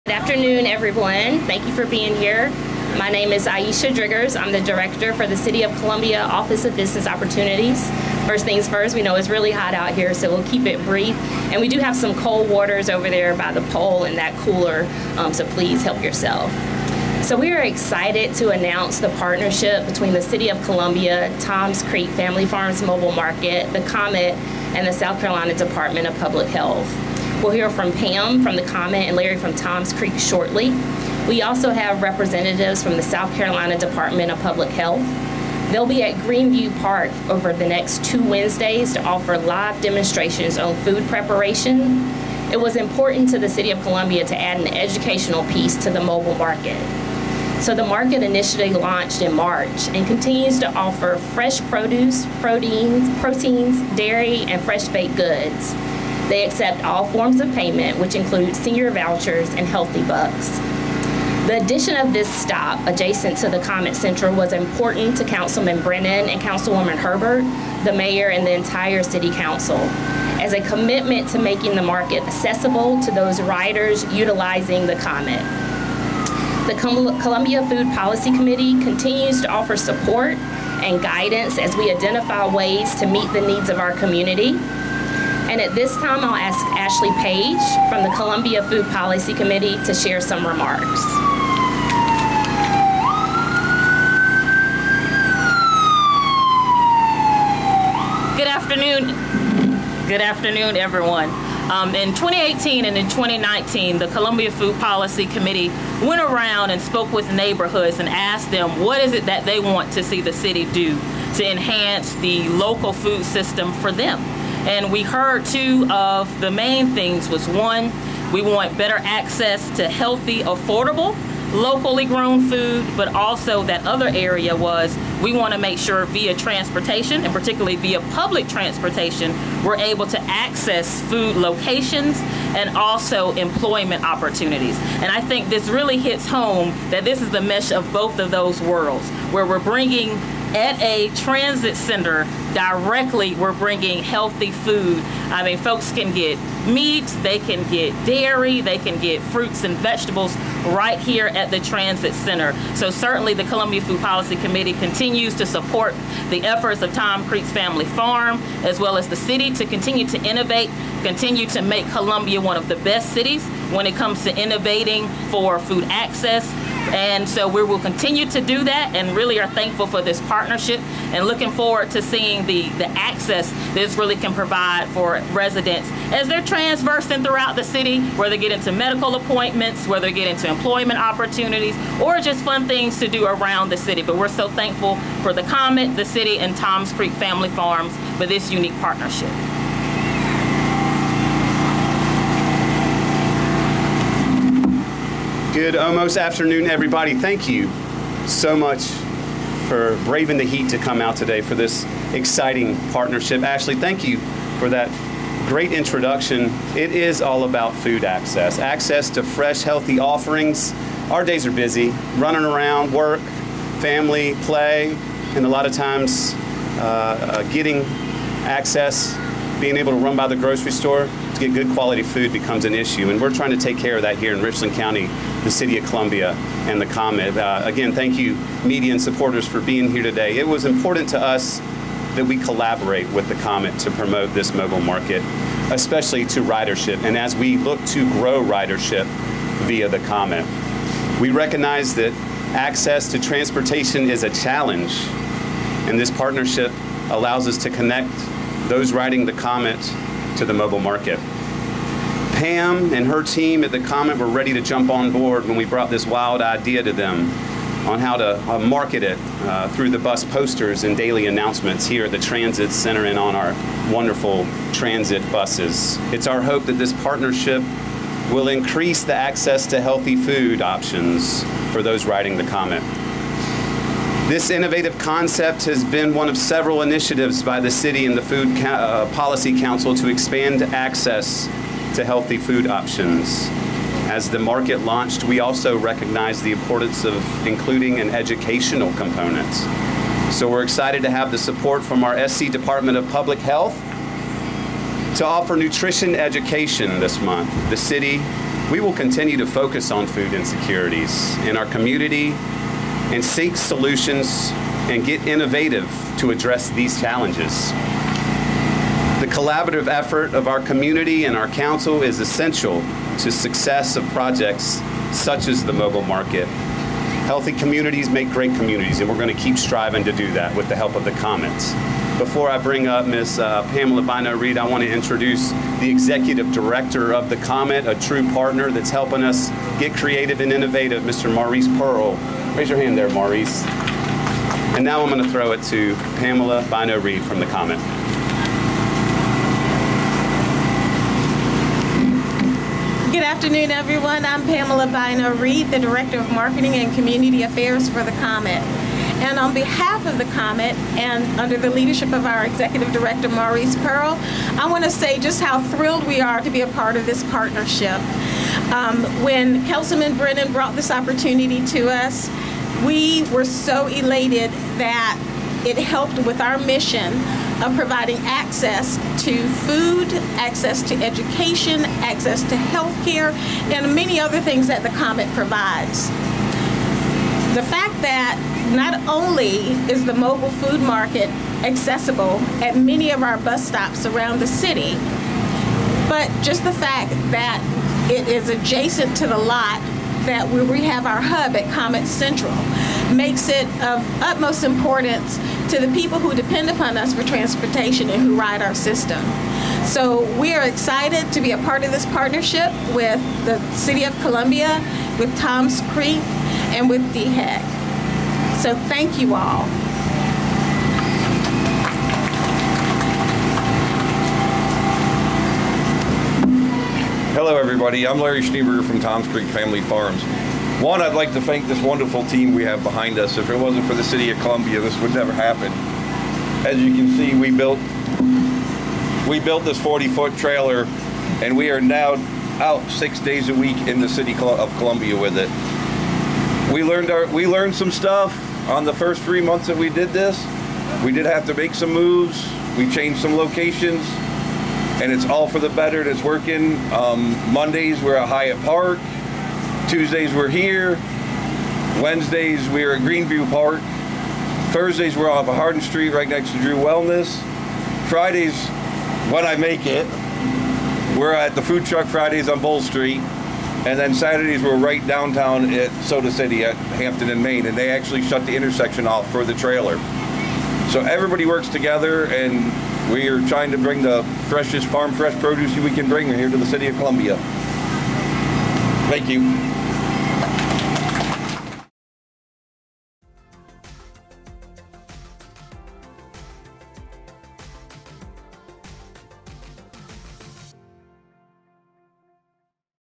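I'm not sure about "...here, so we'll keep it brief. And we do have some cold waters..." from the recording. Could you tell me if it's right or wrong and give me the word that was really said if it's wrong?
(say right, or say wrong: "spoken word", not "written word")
right.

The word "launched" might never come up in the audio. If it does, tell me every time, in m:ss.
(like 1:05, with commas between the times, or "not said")
0:48, 4:44.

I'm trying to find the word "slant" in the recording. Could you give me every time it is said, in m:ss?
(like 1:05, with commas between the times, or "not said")
not said.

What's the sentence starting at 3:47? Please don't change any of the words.
Uh, again, thank you, media and supporters, for being here today.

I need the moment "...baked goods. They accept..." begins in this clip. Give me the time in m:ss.
0:54.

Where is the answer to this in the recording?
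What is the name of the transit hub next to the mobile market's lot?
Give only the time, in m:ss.
6:31.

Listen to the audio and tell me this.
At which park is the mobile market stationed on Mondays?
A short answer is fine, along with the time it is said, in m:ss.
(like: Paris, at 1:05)
Hyatt Park, at 7:28.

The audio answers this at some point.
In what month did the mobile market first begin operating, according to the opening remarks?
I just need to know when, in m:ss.
0:49.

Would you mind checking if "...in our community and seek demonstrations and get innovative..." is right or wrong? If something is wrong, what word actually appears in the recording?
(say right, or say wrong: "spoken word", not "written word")
wrong: "solutions", not "demonstrations".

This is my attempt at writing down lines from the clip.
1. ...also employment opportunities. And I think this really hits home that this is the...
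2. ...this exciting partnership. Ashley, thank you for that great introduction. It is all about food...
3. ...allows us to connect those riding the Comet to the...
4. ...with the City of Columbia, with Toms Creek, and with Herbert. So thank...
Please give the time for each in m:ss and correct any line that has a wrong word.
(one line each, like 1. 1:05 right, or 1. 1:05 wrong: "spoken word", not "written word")
1. 2:12 right
2. 3:21 right
3. 4:07 right
4. 6:42 wrong: "DHEC", not "Herbert".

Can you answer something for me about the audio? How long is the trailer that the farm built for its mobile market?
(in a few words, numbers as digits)
40 feet.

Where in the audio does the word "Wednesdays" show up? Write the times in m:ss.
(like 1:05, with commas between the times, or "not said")
0:38, 7:32.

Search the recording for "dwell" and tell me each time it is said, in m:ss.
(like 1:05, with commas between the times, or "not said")
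not said.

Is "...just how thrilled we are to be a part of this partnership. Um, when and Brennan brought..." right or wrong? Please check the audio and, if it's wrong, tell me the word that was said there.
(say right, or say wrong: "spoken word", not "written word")
right.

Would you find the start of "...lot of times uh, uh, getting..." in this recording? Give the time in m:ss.
3:35.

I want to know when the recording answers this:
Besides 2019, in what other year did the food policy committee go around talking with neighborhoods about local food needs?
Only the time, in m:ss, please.
1:42.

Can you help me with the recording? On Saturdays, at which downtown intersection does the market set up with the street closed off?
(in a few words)
Hampton and Main.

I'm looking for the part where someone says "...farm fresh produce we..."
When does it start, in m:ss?
7:54.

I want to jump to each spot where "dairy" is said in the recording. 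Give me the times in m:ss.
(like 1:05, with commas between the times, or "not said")
0:53, 2:28.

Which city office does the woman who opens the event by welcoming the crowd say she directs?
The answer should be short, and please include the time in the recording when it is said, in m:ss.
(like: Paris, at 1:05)
Office of Business Opportunities, at 0:06.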